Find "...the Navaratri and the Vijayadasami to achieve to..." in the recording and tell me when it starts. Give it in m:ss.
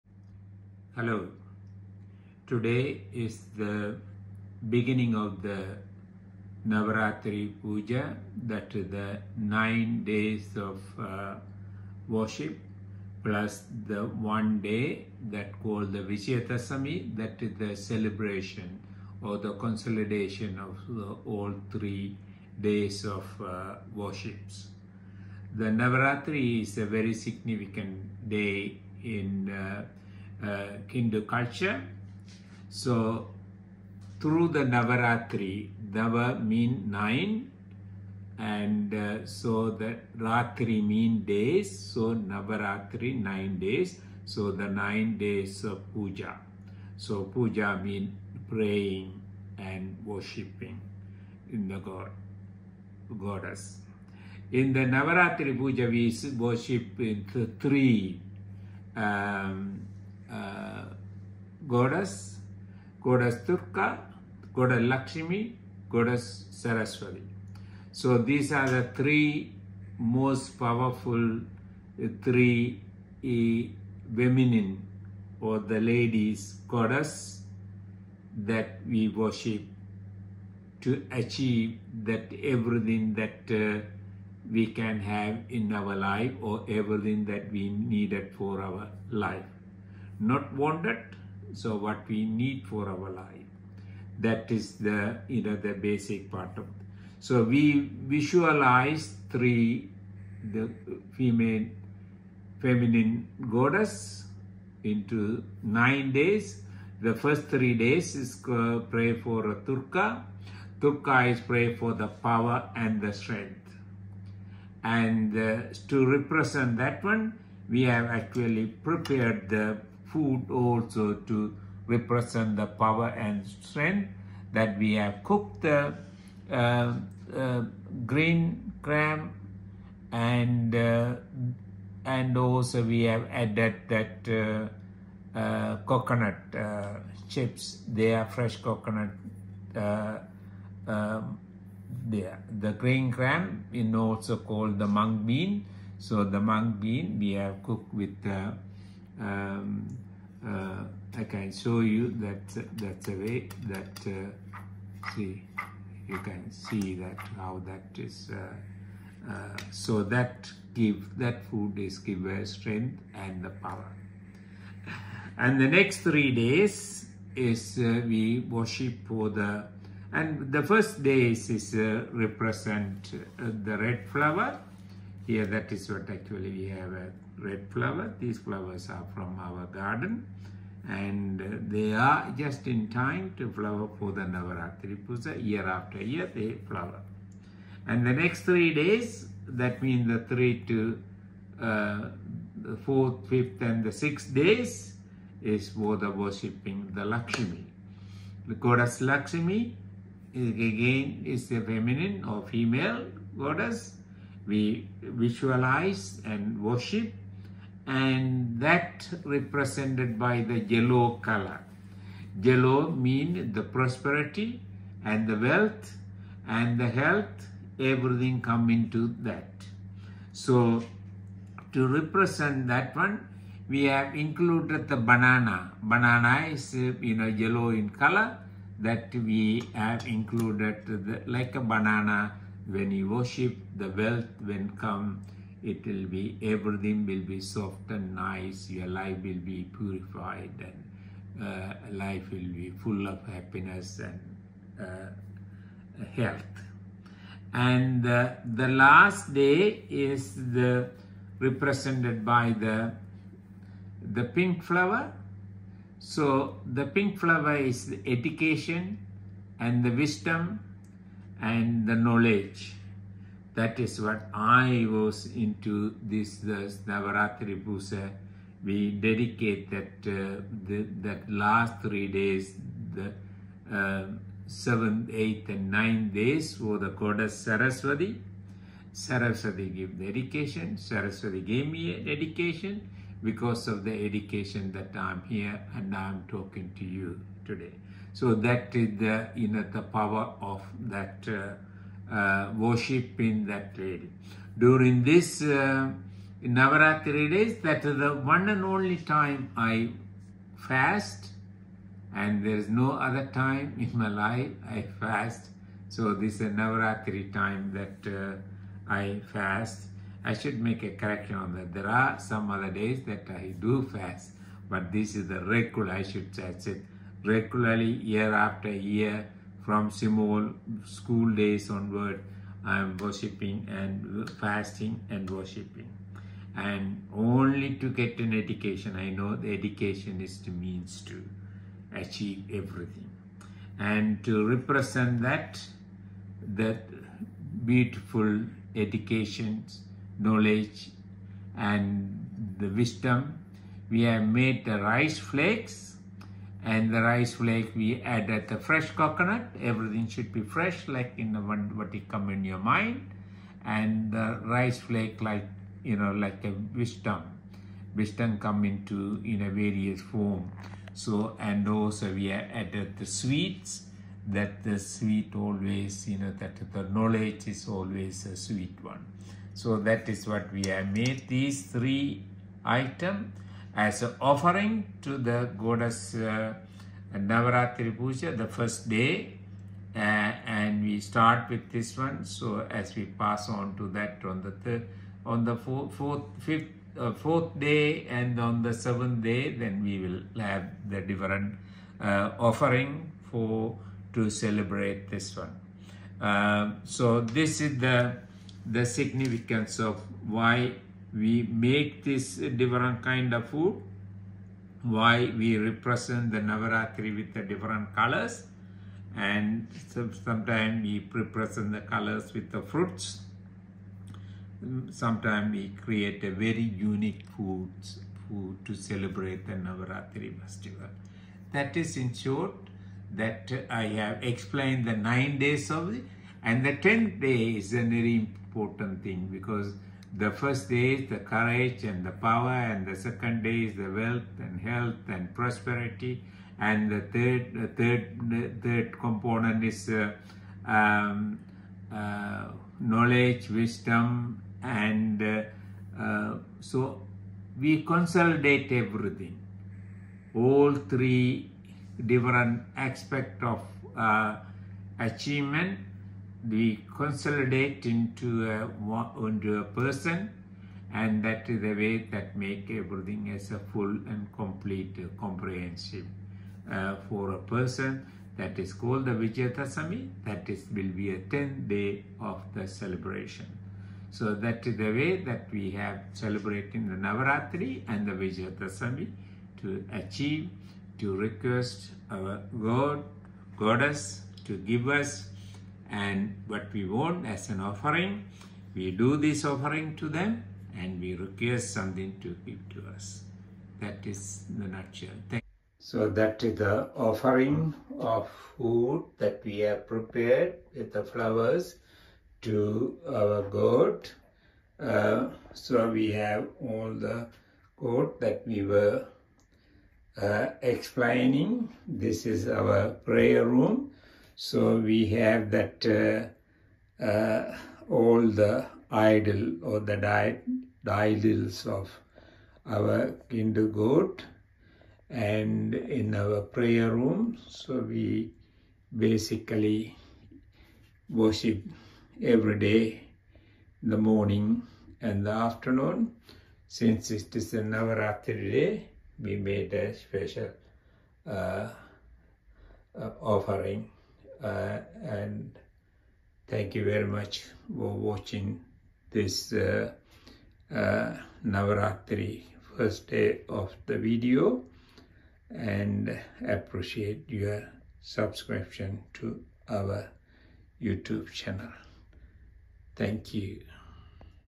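7:56.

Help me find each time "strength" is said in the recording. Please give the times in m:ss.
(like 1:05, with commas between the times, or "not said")
1:53, 2:03, 2:42.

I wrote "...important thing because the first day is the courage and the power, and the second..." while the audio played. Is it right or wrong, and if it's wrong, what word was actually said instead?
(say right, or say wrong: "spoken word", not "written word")
right.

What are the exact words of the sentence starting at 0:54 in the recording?
In the Navaratri puja, we worship in the three um, uh, goddess, goddess Durga, goddess Lakshmi, goddess Saraswati.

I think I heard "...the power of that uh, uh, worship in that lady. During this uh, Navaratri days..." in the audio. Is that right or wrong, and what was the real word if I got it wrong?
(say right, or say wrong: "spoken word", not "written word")
right.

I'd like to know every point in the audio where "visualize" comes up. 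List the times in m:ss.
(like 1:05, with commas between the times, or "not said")
1:38, 3:25.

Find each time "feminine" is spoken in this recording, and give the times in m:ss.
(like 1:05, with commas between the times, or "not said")
1:14, 1:42, 3:21.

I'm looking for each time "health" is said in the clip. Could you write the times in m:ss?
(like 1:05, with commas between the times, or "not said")
3:36, 4:06, 7:14.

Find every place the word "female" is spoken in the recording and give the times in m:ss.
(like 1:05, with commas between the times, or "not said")
1:41, 3:22.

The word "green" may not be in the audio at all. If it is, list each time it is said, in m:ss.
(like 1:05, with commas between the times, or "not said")
2:08, 2:22.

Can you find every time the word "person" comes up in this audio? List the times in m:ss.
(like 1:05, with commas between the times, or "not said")
7:39, 7:47.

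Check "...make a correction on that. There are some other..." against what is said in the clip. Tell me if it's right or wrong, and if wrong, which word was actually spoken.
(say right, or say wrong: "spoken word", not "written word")
right.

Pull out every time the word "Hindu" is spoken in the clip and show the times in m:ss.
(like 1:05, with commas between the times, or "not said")
0:30, 8:43.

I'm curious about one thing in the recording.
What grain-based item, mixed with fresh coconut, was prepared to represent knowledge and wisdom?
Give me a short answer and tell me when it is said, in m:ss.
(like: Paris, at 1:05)
Rice flakes, at 5:44.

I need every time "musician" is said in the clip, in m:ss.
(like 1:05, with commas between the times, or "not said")
not said.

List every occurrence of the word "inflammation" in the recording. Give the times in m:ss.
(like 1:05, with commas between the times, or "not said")
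not said.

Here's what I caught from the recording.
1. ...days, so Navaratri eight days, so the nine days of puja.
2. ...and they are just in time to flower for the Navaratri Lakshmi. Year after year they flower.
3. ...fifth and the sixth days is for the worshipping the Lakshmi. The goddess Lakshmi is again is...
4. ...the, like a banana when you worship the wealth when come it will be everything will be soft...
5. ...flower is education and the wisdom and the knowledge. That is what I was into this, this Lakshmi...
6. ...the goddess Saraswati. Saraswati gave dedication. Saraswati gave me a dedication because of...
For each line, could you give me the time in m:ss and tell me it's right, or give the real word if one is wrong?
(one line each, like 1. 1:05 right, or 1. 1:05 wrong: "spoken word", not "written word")
1. 0:41 wrong: "nine", not "eight"
2. 3:00 wrong: "Puja", not "Lakshmi"
3. 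3:13 right
4. 3:50 right
5. 4:17 wrong: "Navaratri", not "Lakshmi"
6. 4:36 right.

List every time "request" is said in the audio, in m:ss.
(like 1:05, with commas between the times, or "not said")
8:01, 8:11.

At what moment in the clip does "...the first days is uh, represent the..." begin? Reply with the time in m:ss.
2:50.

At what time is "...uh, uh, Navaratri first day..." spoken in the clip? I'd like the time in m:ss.
9:09.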